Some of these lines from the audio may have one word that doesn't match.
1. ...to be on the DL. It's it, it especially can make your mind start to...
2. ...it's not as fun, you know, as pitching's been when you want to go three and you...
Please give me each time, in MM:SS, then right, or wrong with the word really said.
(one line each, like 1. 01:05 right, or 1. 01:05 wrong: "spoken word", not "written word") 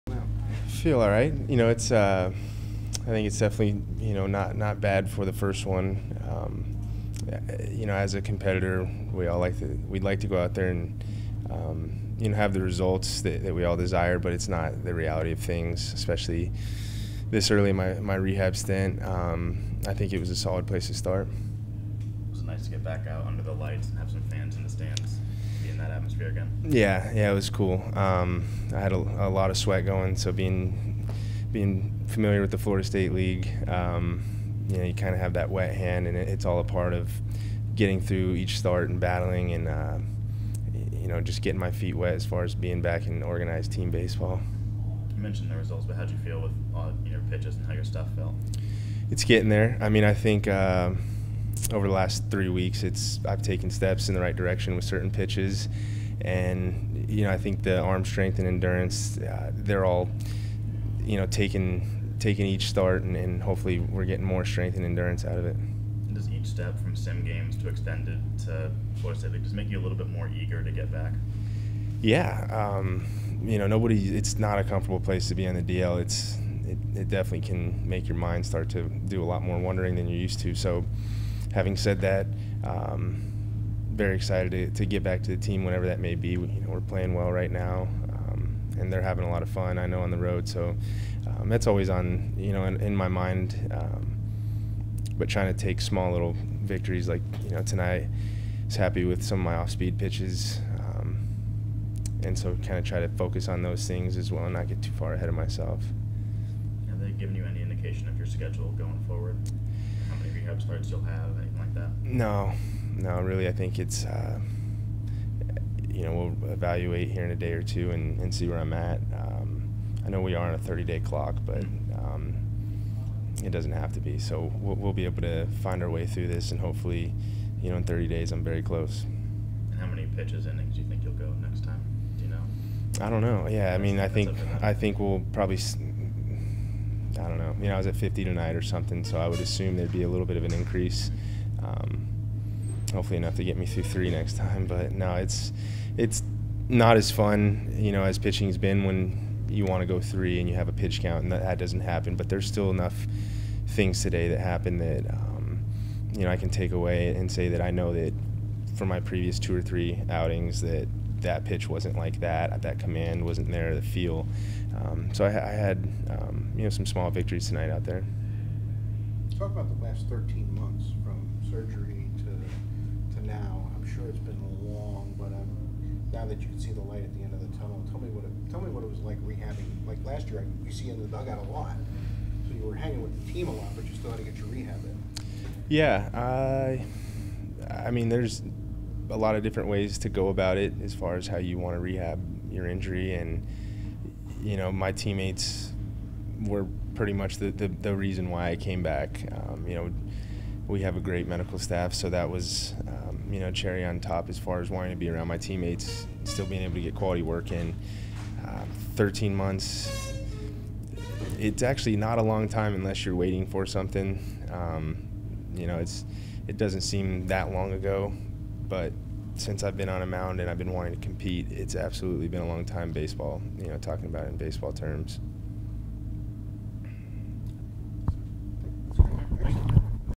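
1. 01:15 wrong: "definitely", not "especially"
2. 02:25 right.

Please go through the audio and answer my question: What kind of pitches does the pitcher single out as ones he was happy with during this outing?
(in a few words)
off-speed pitches.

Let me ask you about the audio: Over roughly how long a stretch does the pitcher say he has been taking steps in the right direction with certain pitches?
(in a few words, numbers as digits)
three weeks.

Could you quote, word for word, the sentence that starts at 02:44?
Um, so I, I had um, you know some small victories tonight out there.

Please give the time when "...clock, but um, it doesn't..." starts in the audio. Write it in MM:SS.
02:00.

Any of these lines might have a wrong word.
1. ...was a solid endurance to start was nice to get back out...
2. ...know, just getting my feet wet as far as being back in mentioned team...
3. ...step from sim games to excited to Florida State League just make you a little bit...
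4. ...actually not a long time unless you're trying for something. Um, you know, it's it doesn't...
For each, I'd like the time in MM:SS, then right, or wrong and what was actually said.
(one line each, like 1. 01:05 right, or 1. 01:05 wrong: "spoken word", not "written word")
1. 00:20 wrong: "place", not "endurance"
2. 00:41 wrong: "organized", not "mentioned"
3. 01:06 wrong: "extended", not "excited"
4. 03:31 wrong: "waiting", not "trying".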